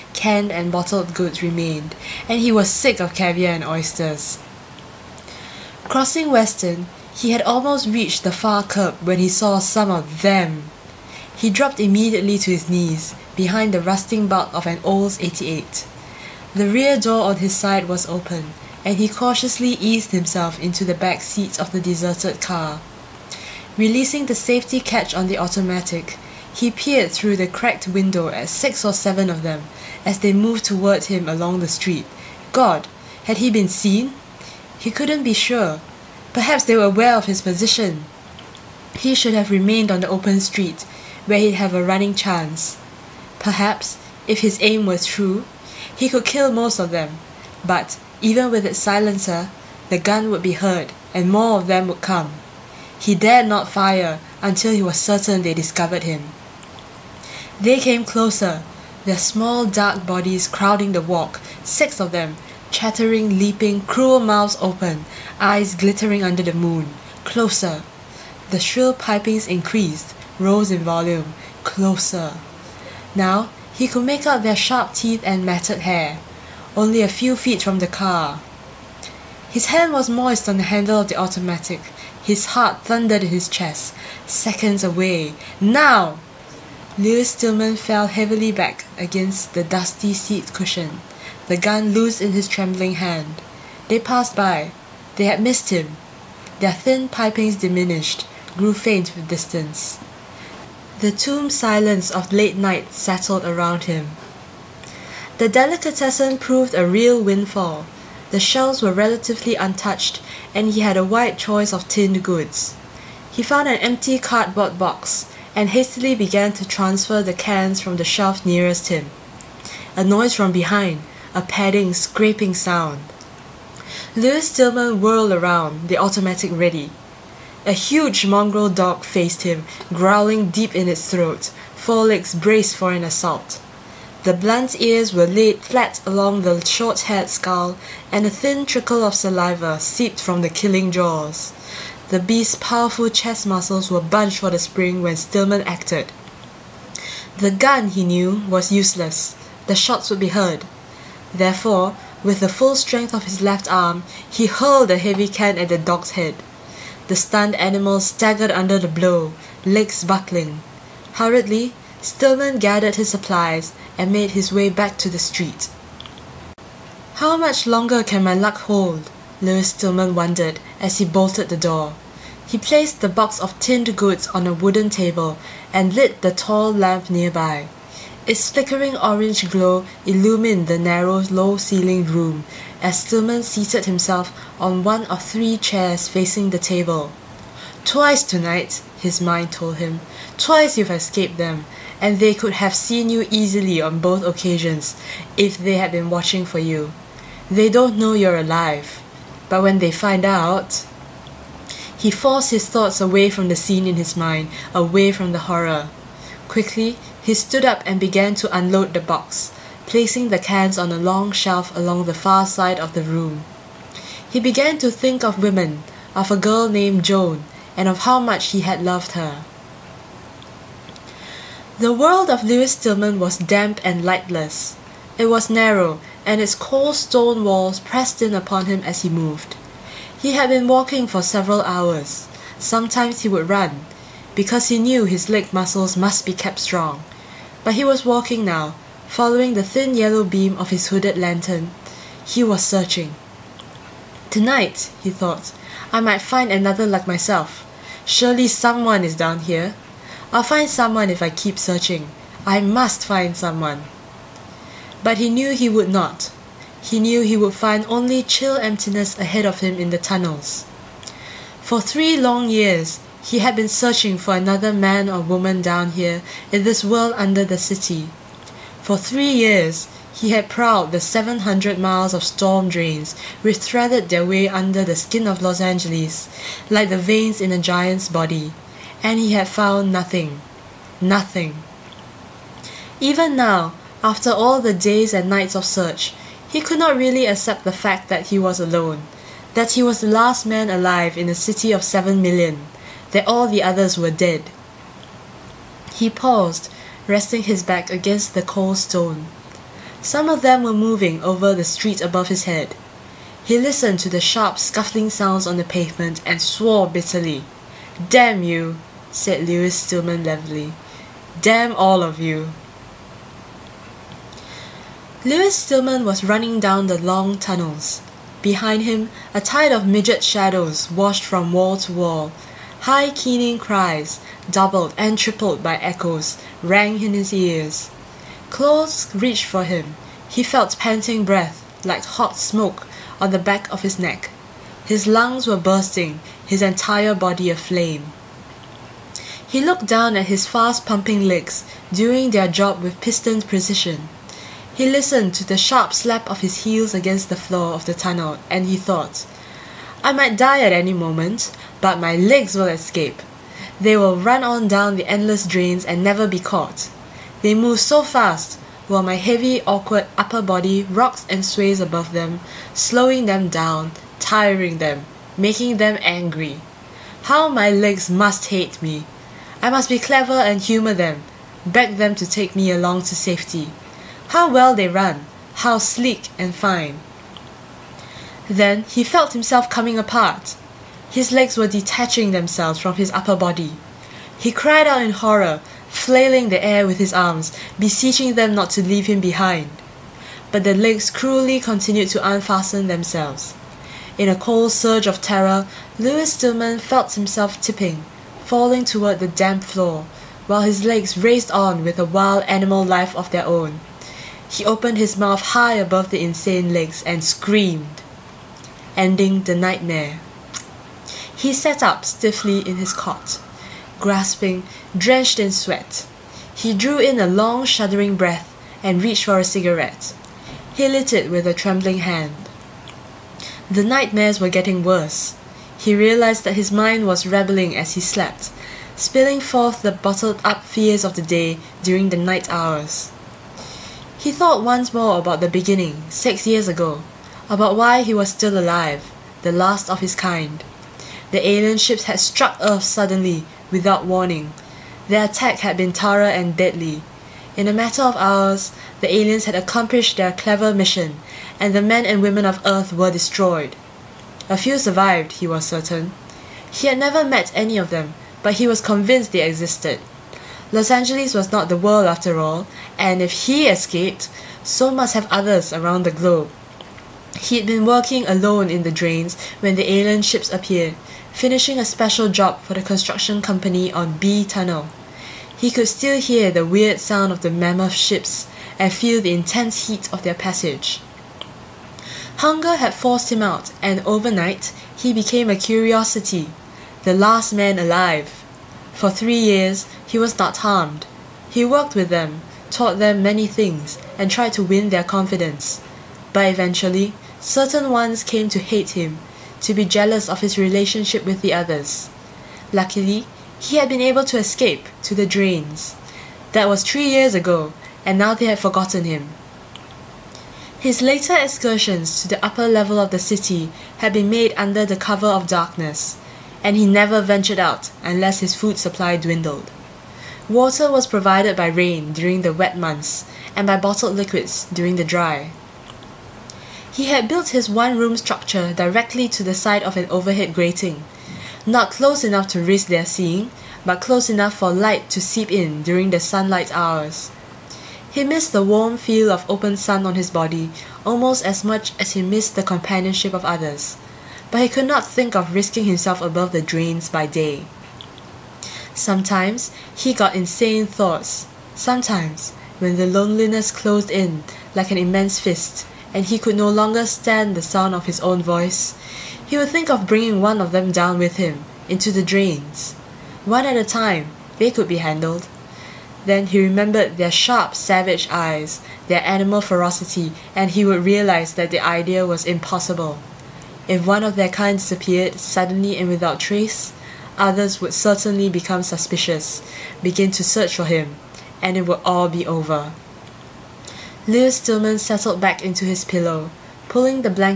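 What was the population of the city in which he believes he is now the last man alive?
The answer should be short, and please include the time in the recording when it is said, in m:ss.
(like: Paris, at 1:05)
7 million, at 4:51.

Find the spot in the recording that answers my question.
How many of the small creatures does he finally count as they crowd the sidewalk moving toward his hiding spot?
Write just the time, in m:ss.
1:01.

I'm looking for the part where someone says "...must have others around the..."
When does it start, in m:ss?
7:44.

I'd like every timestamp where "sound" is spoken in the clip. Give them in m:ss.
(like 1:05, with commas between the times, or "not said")
2:02, 5:05, 7:57, 9:17.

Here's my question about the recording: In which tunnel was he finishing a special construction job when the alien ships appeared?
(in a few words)
B Tunnel.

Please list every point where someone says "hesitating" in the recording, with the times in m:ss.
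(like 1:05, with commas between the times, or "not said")
not said.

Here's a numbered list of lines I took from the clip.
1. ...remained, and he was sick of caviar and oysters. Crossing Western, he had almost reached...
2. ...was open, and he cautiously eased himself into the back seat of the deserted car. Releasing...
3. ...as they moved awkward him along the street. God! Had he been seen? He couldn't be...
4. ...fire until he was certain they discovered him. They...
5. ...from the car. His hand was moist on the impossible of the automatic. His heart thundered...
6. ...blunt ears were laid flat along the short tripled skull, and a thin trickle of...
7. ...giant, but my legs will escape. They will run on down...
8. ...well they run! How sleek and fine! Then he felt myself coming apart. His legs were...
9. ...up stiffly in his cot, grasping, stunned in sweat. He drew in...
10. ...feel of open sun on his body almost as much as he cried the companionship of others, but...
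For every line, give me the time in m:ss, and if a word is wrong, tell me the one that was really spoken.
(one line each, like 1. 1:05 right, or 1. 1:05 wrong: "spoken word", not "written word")
1. 0:01 right
2. 0:17 right
3. 0:30 wrong: "toward", not "awkward"
4. 0:53 right
5. 1:17 wrong: "handle", not "impossible"
6. 2:14 wrong: "haired", not "tripled"
7. 5:50 wrong: "moment", not "giant"
8. 6:14 wrong: "himself", not "myself"
9. 6:51 wrong: "drenched", not "stunned"
10. 8:58 wrong: "missed", not "cried".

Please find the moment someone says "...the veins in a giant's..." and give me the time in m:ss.
4:36.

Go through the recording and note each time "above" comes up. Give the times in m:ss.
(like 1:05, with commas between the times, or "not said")
5:02, 6:01, 6:45, 9:06.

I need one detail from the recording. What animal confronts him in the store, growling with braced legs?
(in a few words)
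mongrel dog.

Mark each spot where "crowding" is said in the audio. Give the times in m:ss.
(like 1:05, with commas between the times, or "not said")
1:00.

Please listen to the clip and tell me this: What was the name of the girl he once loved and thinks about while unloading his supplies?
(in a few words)
Joan.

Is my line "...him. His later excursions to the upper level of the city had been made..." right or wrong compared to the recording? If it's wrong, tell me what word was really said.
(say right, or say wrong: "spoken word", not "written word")
right.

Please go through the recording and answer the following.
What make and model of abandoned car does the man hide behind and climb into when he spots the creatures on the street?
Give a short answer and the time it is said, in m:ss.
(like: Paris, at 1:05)
Olds 88, at 0:14.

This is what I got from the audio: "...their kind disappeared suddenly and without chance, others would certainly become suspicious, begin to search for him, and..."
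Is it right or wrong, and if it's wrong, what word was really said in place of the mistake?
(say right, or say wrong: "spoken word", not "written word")
wrong: "trace", not "chance".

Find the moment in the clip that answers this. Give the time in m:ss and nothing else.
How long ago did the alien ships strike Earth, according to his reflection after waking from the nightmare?
7:16.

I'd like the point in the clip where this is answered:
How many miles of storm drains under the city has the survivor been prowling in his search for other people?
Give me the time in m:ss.
4:30.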